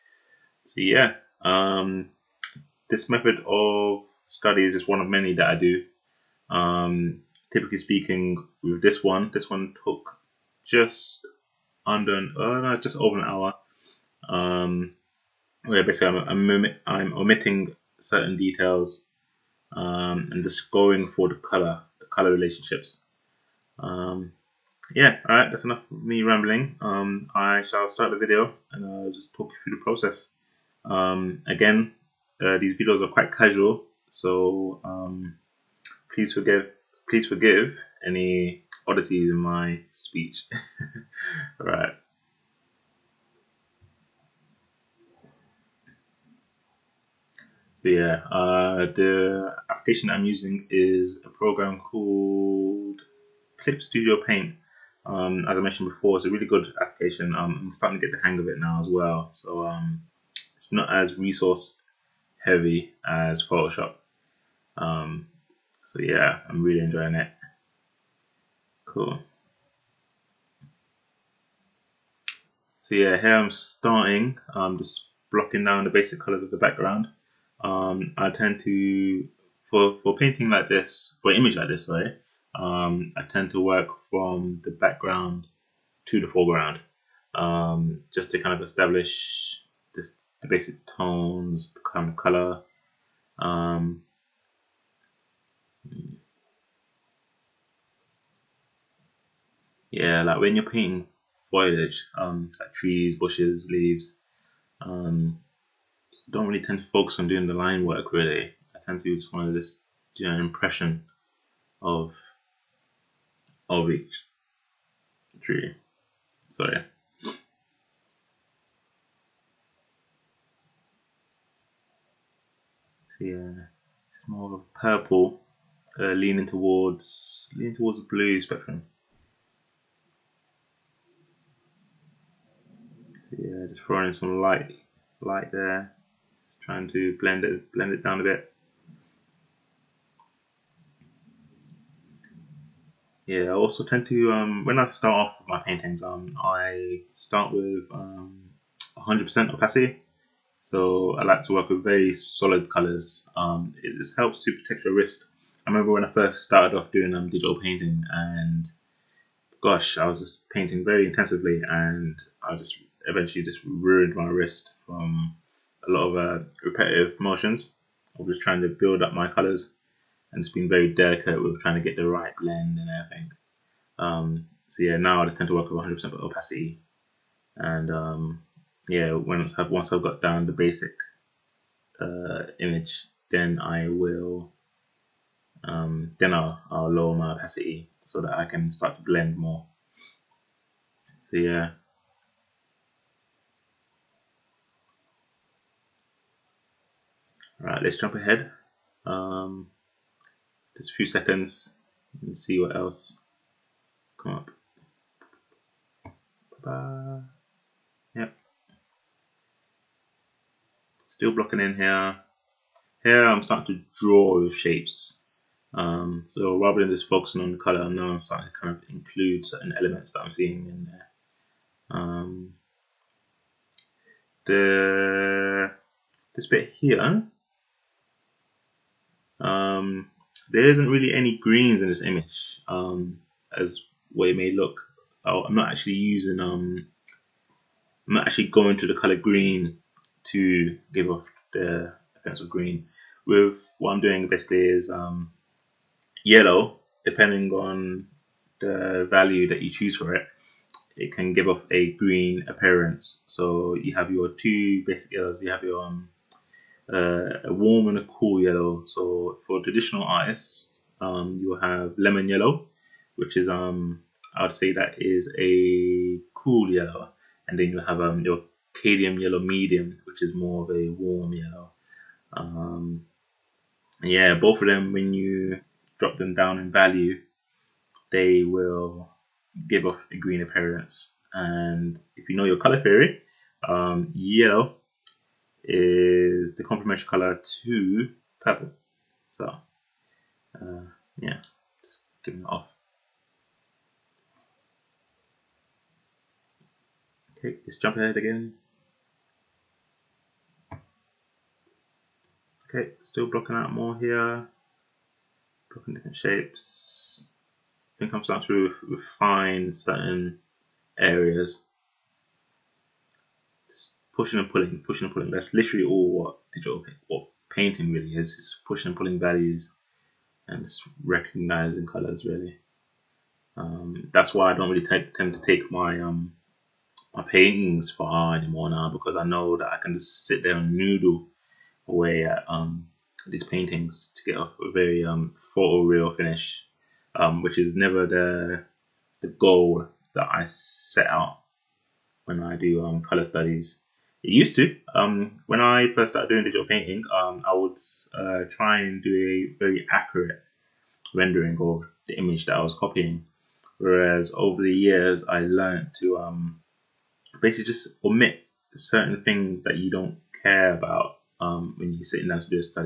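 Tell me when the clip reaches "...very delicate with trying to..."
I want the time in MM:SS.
02:50.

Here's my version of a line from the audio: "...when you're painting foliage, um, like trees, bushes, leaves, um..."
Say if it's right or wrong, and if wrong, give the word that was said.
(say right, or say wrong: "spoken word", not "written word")
right.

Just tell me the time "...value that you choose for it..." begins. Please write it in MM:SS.
04:09.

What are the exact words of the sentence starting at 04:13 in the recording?
So you have your two basic yellows, you have your um, uh, a warm and a cool yellow.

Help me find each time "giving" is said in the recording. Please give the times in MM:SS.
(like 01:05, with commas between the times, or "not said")
04:52.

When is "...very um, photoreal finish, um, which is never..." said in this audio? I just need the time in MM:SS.
05:34.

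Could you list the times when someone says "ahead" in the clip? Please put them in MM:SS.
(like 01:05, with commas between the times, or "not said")
03:18, 04:57.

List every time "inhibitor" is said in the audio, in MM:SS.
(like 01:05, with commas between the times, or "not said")
not said.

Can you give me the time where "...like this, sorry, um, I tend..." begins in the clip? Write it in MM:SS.
01:21.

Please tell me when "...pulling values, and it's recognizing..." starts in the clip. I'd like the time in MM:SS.
05:18.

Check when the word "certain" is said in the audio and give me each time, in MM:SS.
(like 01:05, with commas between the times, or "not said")
00:17, 03:39, 05:09, 05:58.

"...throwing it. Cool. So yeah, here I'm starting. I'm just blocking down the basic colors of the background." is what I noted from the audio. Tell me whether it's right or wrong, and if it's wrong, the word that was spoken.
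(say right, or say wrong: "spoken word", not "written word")
wrong: "enjoying", not "throwing".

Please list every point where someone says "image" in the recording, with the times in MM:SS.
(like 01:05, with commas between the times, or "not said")
01:21, 03:02, 03:52, 05:52.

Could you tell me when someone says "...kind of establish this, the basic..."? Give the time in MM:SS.
01:28.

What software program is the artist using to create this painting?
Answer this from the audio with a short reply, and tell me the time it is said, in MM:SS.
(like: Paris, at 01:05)
Clip Studio Paint, at 00:53.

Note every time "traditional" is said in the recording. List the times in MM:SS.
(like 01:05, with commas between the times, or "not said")
04:19.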